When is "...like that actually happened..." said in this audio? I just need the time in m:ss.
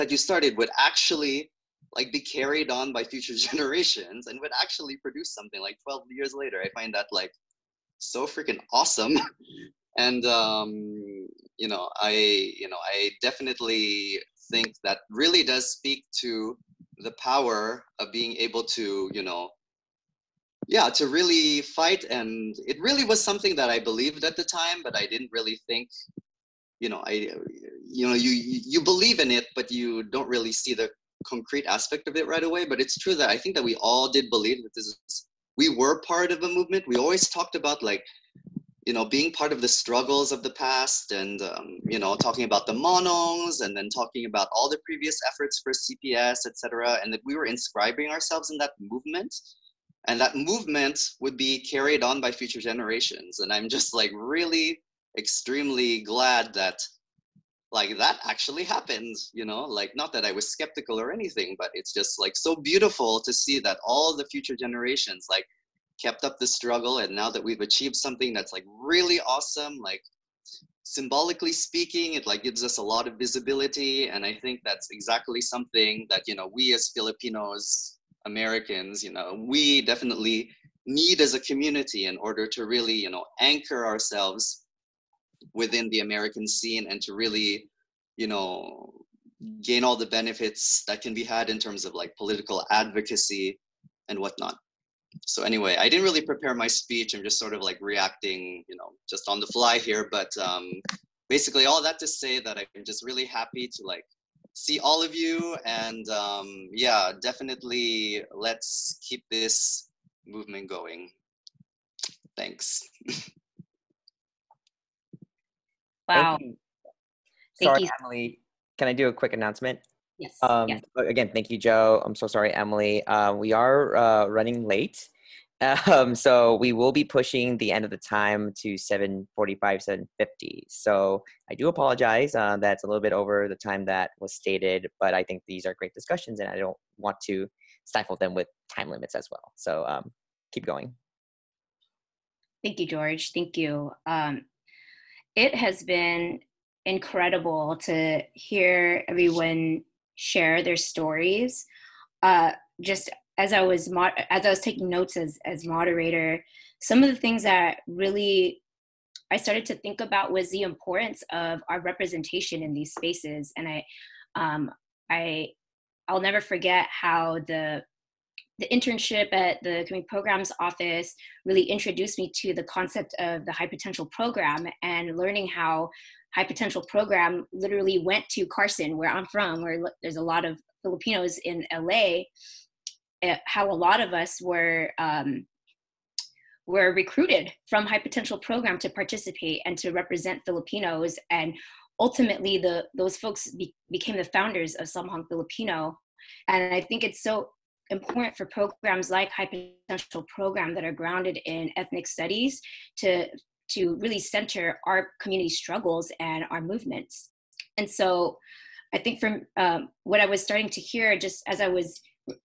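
0:57.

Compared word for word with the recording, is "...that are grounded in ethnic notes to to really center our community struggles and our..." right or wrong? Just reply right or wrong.
wrong.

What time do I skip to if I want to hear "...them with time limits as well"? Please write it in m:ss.
2:18.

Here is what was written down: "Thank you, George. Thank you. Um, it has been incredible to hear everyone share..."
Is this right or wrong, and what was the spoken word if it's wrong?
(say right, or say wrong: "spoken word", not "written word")
right.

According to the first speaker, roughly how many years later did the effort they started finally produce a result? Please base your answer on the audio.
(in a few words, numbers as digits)
12 years.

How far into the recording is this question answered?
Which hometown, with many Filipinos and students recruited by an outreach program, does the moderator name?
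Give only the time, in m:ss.
2:58.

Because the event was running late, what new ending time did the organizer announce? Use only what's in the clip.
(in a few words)
7:45 to 7:50.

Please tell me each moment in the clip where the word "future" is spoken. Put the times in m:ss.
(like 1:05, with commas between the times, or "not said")
0:03, 0:52, 1:04.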